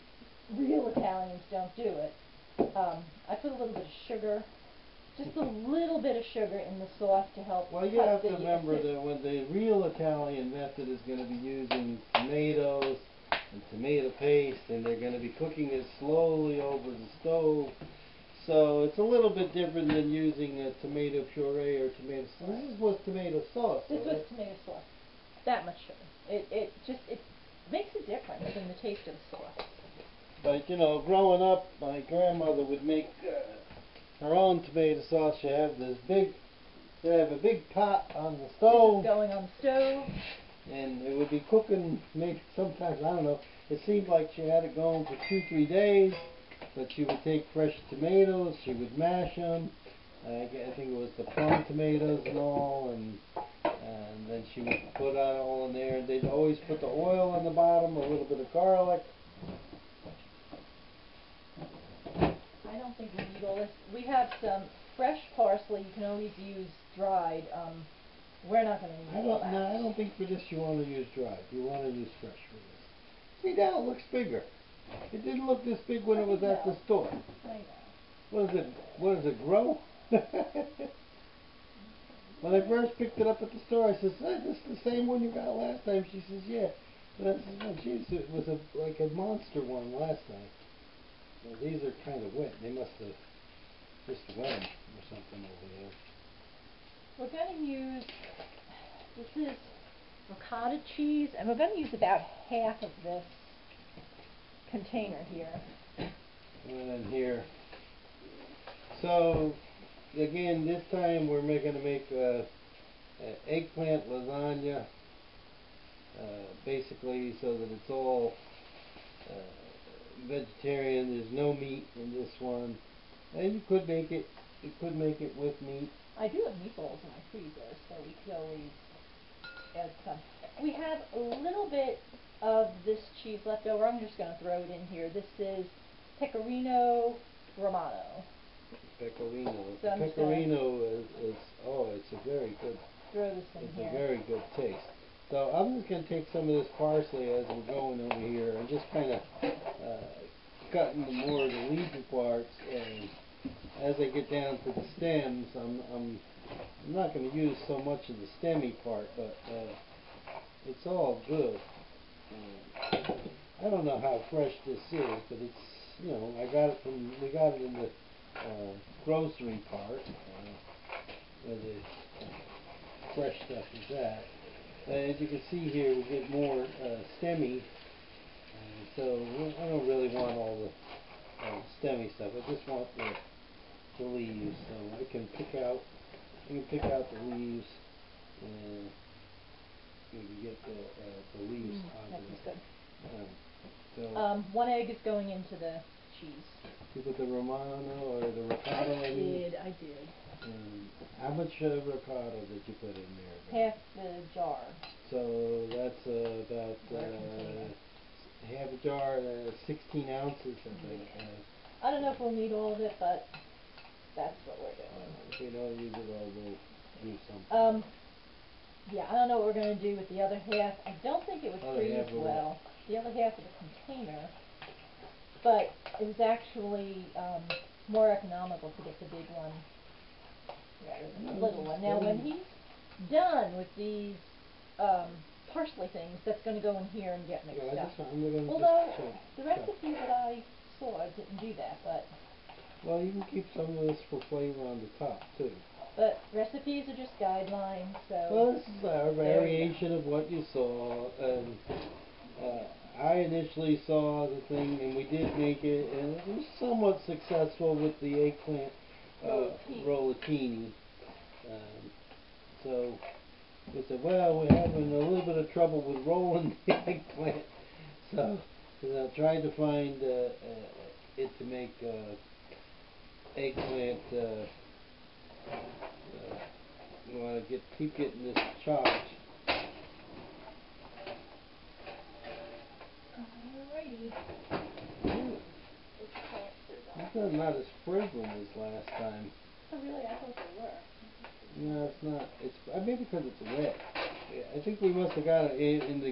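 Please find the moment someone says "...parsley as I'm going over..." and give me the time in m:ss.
2:26.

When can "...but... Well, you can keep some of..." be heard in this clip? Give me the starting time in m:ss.
4:01.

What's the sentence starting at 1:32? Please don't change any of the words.
They must have just wet or something over there.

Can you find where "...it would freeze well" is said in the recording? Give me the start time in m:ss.
3:41.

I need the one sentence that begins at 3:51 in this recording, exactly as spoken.
Now, when he's done with these um, parsley things, that's going to go in here and get mixed yeah, up.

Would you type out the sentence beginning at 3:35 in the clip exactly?
If uh, we don't use it all, we'll do something.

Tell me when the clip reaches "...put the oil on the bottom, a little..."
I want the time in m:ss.
0:56.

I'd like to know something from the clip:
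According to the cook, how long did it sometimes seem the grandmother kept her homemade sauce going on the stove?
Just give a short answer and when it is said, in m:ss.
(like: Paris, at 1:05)
2-3 days, at 0:45.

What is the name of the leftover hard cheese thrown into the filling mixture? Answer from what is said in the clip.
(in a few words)
pecorino romano.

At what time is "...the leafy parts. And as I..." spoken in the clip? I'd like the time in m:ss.
2:31.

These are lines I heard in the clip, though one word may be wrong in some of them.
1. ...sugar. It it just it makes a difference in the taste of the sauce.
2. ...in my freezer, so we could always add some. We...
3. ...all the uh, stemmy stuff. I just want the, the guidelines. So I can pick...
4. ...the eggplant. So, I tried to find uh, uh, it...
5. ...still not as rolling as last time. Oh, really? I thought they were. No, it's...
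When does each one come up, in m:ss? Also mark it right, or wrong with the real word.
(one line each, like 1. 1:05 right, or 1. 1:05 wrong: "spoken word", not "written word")
1. 0:25 right
2. 2:07 right
3. 3:00 wrong: "leaves", not "guidelines"
4. 4:26 right
5. 4:47 wrong: "frizzling", not "rolling".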